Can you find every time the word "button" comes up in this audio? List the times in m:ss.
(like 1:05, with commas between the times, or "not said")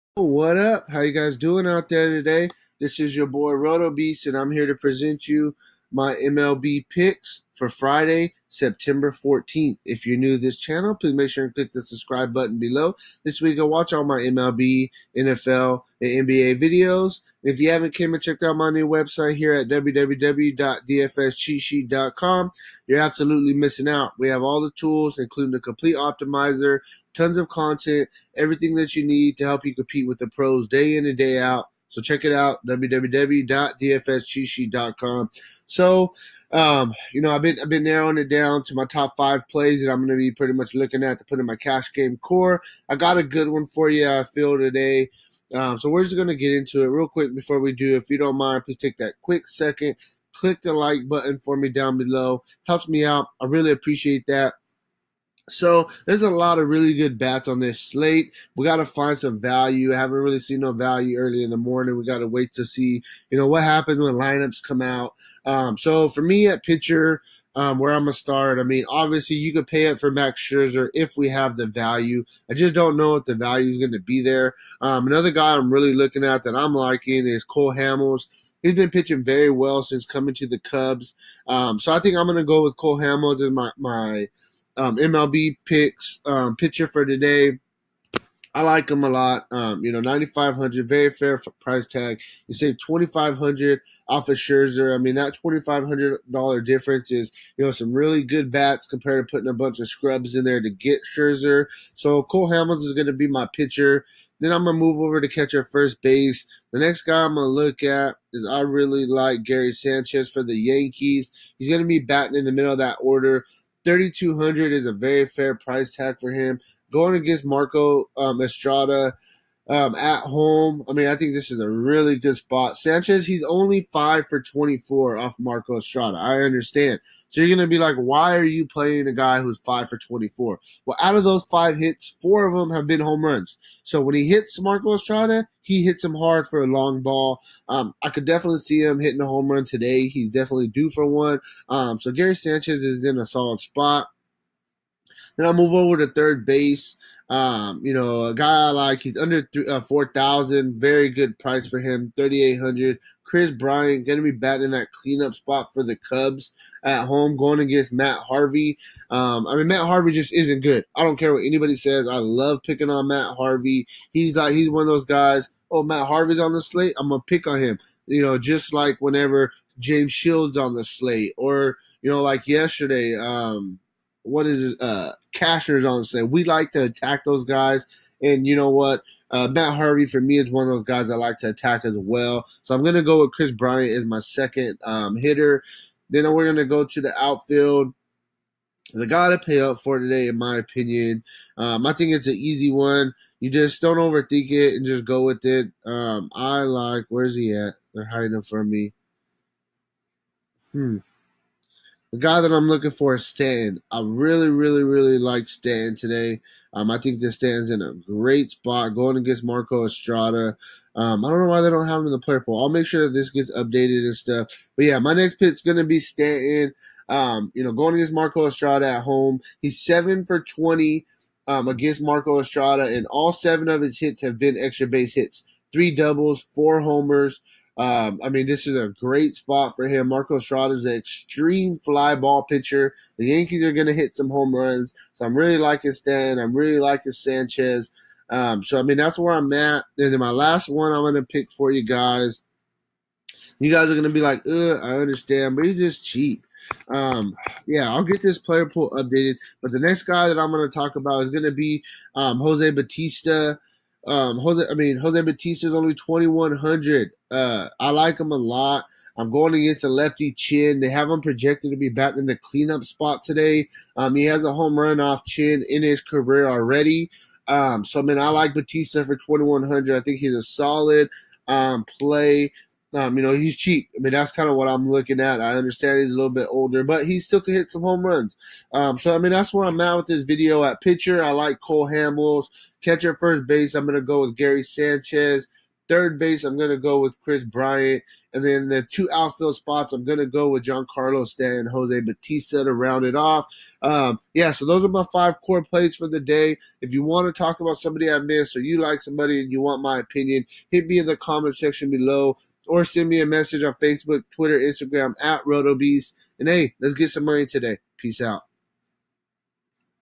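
0:12, 0:51.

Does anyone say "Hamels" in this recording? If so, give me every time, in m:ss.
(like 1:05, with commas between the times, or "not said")
1:17, 1:22, 1:42, 4:41.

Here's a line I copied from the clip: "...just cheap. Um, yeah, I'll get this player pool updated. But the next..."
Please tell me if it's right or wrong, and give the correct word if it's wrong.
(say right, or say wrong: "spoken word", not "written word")
right.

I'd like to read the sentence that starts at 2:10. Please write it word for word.
Well, out of those five hits, four of them have been home runs.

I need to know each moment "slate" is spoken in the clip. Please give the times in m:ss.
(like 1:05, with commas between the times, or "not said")
0:57, 2:46, 2:50.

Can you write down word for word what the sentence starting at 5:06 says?
And hey, let's get some money today.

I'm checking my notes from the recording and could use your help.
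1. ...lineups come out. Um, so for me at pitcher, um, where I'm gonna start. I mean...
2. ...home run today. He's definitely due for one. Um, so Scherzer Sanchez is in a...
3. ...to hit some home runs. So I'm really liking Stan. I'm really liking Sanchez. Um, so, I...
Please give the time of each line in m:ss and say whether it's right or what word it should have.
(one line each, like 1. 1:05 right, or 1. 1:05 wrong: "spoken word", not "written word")
1. 1:04 right
2. 2:19 wrong: "Gary", not "Scherzer"
3. 3:53 right.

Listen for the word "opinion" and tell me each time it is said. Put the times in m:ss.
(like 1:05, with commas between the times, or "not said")
3:10, 4:59.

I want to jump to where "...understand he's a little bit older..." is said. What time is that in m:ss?
4:35.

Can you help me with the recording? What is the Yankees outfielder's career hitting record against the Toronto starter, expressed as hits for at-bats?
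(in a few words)
7 for 20.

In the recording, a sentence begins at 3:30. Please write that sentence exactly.
Um, I don't know why they don't have him in the player pool.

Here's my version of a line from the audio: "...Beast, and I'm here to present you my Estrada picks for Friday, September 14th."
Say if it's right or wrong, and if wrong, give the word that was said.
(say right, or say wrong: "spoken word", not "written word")
wrong: "MLB", not "Estrada".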